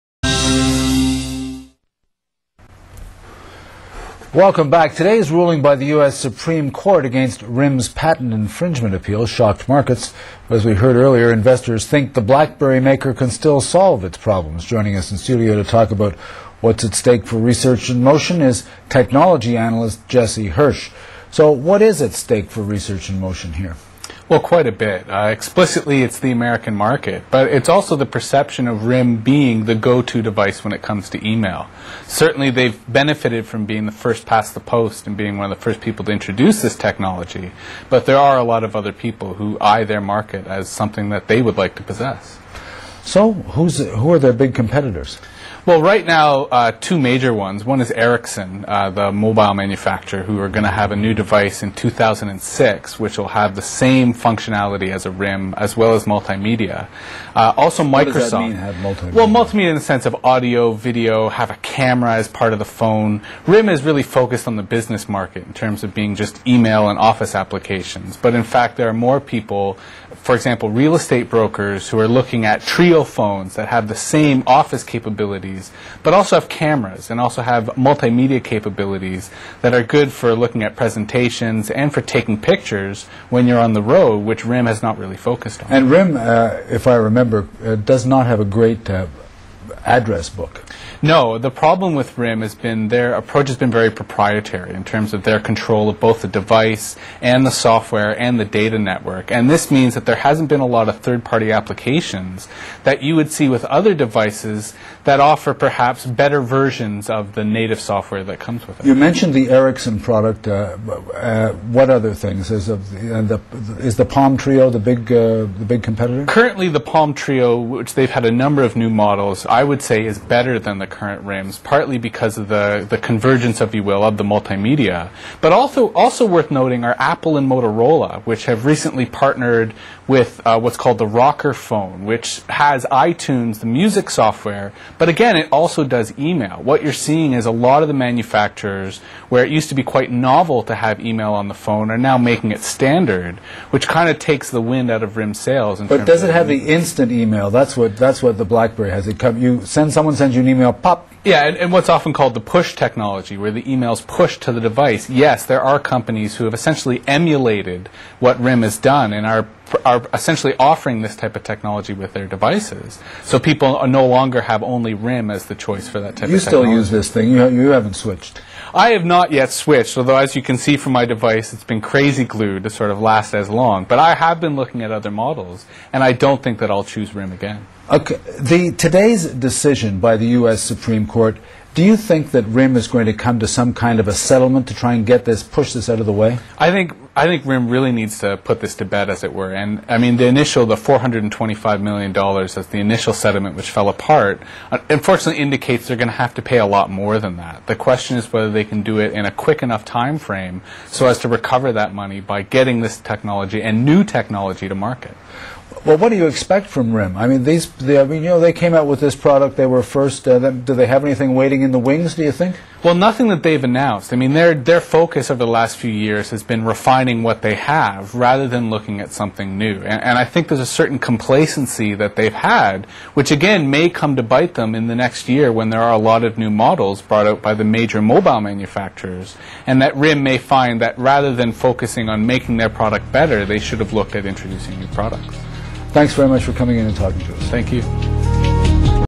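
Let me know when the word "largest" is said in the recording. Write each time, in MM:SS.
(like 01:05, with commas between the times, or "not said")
not said.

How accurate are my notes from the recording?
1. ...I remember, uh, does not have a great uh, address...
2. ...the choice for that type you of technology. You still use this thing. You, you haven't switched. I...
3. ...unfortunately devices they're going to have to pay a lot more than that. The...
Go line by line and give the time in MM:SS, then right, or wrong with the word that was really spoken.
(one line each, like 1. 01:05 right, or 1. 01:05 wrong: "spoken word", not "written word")
1. 01:26 right
2. 02:45 right
3. 03:14 wrong: "indicates", not "devices".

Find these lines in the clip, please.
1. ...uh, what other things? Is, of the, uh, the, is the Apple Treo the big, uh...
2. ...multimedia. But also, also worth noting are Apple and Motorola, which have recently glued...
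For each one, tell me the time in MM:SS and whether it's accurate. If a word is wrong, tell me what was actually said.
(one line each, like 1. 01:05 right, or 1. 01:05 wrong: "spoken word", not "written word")
1. 01:51 wrong: "Palm", not "Apple"
2. 02:04 wrong: "partnered", not "glued".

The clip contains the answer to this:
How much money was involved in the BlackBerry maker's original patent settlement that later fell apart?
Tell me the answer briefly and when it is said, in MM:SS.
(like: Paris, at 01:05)
$425 million, at 03:10.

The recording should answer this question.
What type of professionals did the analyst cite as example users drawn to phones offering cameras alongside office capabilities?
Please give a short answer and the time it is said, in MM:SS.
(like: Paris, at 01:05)
real estate brokers, at 01:10.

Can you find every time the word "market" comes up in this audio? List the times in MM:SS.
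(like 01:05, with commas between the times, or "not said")
00:09, 00:26, 00:39, 01:05, 03:24.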